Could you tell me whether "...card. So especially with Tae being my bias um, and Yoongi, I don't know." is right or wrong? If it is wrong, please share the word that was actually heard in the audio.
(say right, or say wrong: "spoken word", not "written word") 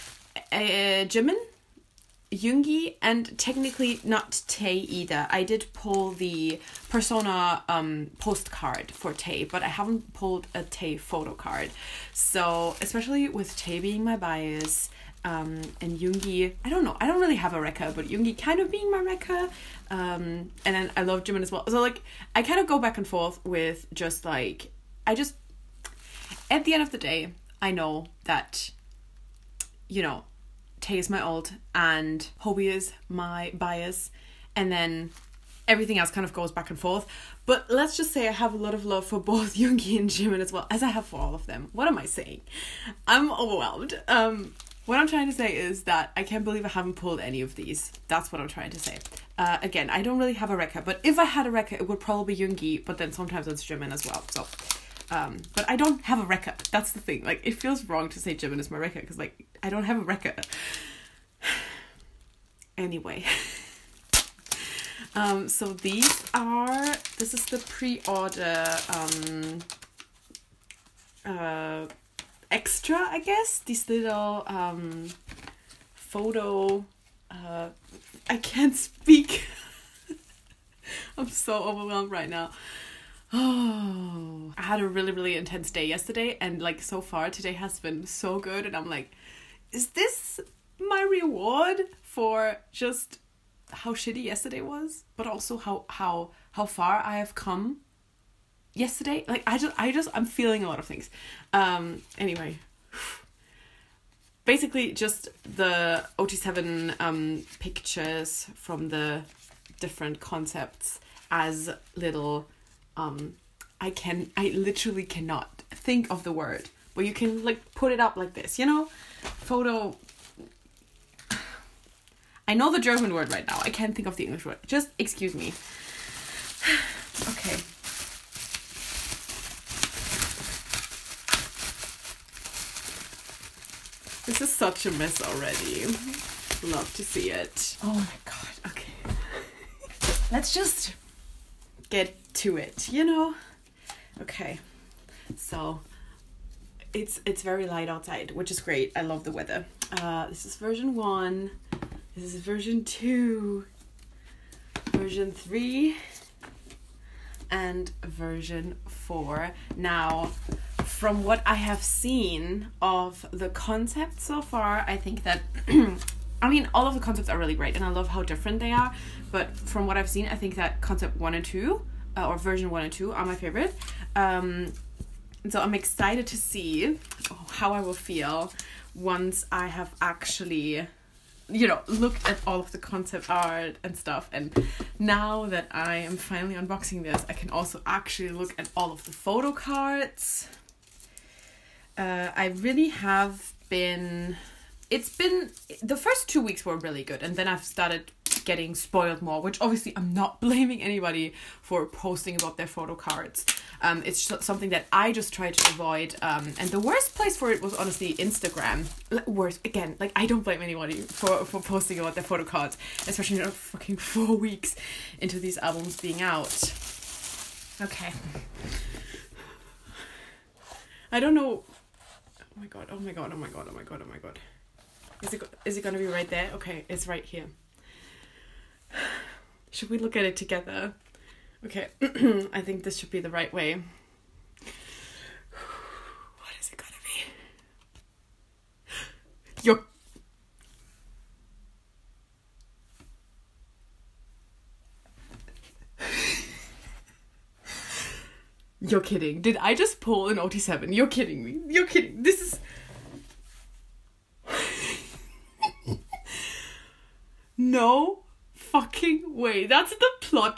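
right.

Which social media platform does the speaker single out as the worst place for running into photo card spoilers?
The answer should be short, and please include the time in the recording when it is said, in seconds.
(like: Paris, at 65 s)
Instagram, at 208 s.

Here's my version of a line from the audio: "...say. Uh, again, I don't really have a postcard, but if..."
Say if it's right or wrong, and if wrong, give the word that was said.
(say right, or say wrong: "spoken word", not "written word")
wrong: "record", not "postcard".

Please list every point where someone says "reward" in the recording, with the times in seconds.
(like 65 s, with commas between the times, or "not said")
91 s.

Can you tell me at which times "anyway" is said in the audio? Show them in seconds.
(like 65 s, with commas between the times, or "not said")
62 s, 102 s.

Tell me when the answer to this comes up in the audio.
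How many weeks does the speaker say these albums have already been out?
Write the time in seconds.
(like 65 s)
213 s.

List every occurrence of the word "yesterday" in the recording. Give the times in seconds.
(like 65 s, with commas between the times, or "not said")
85 s, 94 s, 98 s.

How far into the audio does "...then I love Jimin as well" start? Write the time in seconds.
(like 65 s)
20 s.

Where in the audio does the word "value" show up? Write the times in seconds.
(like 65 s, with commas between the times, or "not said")
not said.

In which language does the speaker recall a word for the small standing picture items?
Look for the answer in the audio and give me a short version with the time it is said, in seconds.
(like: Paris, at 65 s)
German, at 122 s.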